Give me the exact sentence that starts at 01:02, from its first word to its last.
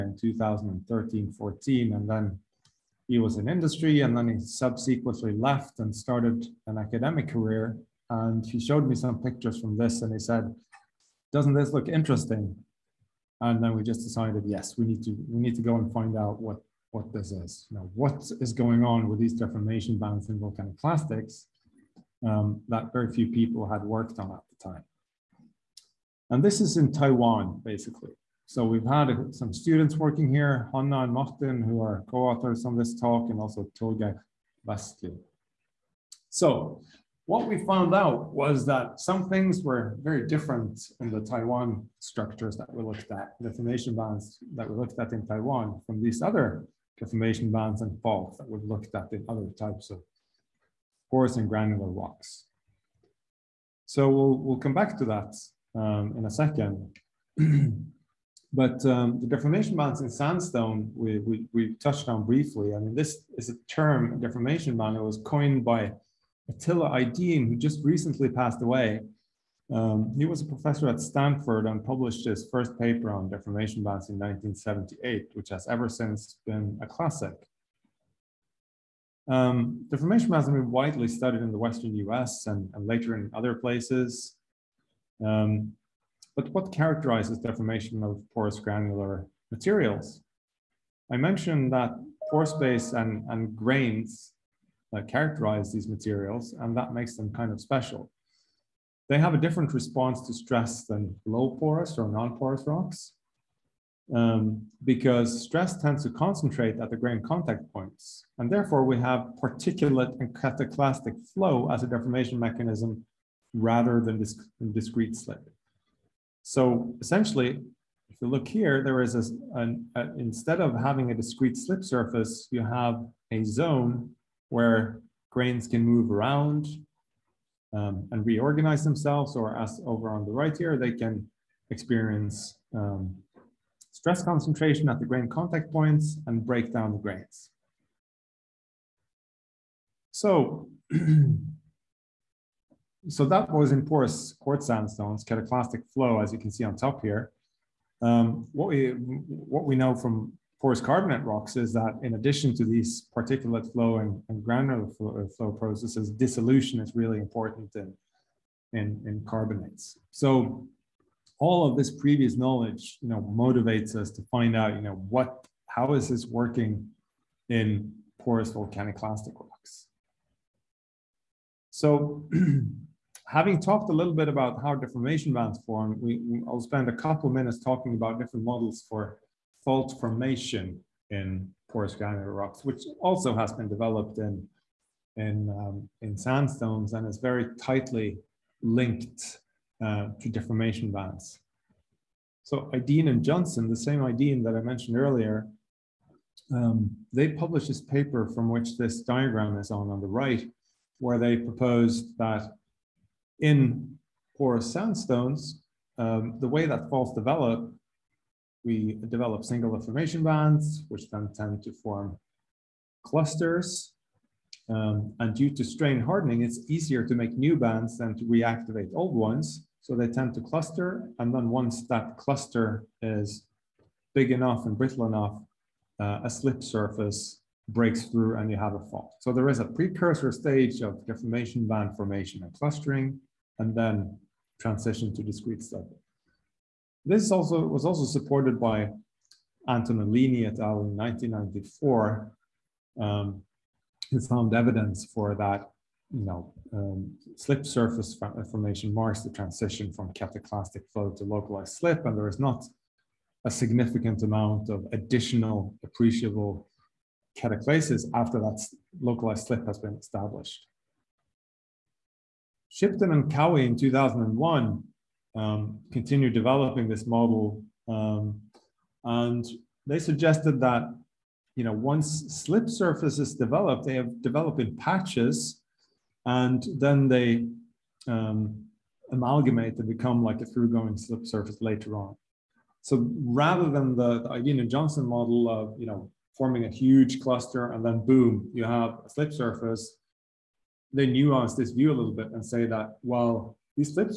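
I mean, this is a term, deformation band.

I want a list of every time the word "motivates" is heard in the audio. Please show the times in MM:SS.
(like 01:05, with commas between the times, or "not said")
02:43.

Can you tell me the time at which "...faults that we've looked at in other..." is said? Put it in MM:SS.
00:48.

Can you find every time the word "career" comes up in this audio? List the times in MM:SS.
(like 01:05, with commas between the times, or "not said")
00:07.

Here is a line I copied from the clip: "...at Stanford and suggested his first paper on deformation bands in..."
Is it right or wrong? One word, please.
wrong.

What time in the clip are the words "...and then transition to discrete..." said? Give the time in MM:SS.
03:53.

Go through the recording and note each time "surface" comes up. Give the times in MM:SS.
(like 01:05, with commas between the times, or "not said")
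02:01, 03:46, 04:07, 04:32, 04:41, 04:49.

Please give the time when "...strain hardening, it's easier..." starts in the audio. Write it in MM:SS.
03:35.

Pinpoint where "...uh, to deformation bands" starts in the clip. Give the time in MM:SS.
03:09.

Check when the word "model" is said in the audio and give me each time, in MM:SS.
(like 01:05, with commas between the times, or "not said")
02:58, 04:27, 04:45.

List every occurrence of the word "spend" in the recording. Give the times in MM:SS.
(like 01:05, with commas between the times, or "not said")
02:56.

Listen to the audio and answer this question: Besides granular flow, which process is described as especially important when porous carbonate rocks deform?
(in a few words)
Dissolution.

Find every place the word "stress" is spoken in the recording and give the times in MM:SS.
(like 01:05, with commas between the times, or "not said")
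01:40, 01:45, 02:13.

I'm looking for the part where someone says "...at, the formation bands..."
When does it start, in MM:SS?
00:43.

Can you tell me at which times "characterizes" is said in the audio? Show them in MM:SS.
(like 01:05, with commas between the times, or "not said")
01:26, 01:35.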